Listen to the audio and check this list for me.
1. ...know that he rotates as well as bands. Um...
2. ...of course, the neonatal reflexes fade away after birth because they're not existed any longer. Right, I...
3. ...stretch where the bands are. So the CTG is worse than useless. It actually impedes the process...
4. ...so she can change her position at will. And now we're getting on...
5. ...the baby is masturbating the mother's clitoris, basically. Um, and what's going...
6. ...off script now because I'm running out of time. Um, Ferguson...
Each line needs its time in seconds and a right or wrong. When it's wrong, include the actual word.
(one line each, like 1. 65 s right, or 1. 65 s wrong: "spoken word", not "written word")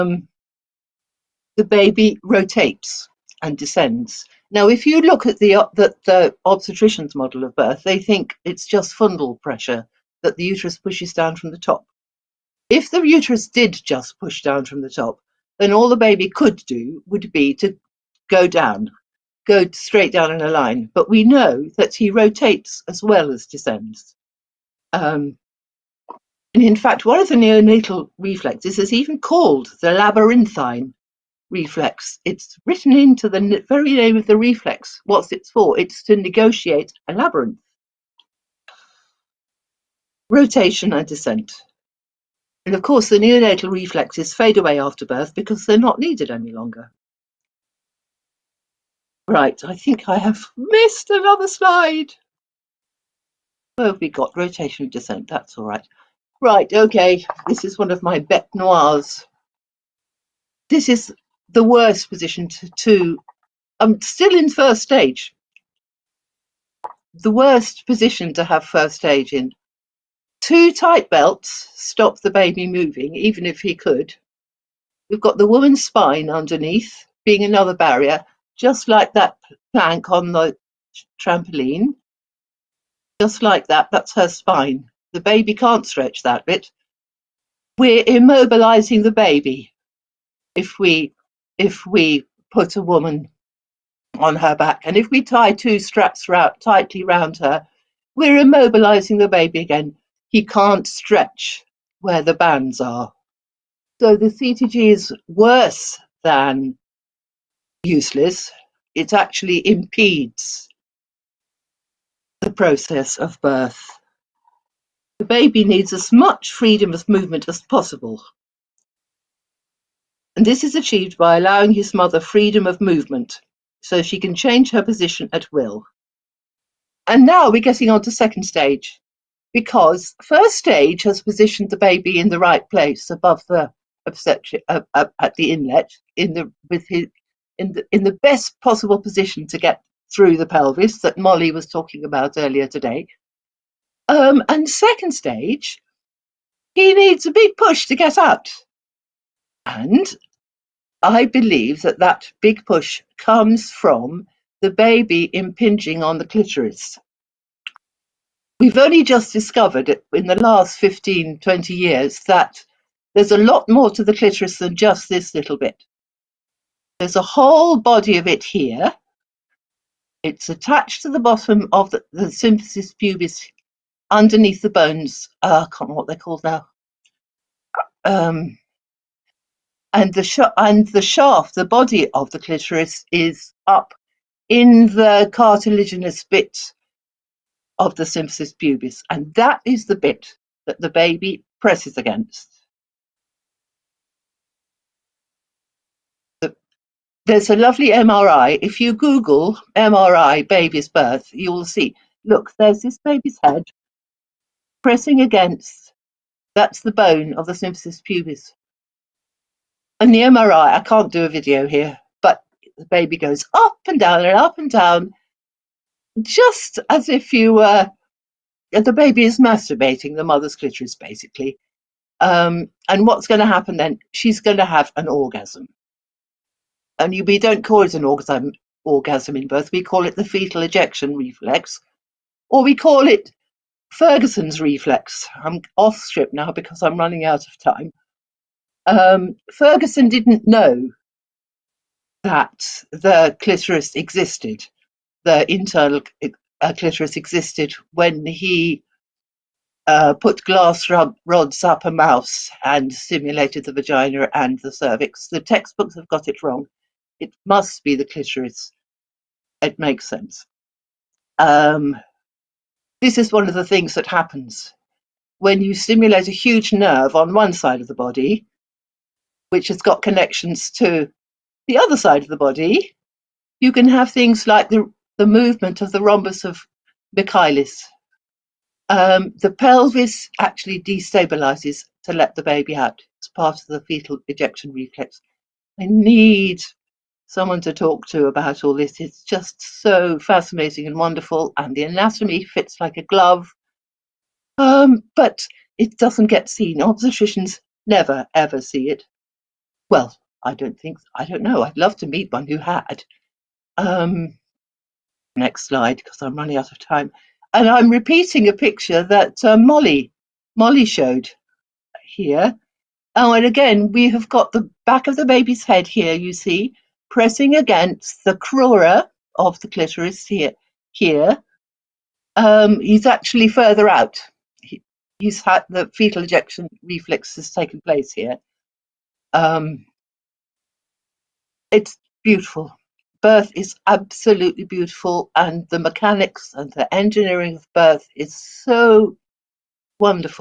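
1. 21 s wrong: "descends", not "bands"
2. 42 s wrong: "needed", not "existed"
3. 100 s right
4. 123 s right
5. 218 s right
6. 235 s right.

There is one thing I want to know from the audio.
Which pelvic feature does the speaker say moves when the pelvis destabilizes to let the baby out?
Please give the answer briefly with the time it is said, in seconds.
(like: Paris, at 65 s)
rhombus of Michaelis, at 276 s.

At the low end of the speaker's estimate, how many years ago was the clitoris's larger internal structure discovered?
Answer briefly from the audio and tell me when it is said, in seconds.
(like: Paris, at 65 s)
15, at 160 s.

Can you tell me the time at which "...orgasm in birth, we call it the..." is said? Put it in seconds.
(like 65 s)
228 s.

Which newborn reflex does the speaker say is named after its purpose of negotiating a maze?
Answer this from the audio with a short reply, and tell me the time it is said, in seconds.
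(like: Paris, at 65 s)
labyrinthine reflex, at 29 s.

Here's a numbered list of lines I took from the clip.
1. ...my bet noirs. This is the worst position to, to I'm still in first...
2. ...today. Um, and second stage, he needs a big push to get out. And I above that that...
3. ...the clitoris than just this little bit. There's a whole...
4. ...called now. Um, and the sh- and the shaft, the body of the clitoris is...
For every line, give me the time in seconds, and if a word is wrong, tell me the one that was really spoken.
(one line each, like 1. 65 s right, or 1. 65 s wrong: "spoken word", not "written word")
1. 58 s right
2. 142 s wrong: "believe", not "above"
3. 164 s right
4. 176 s right.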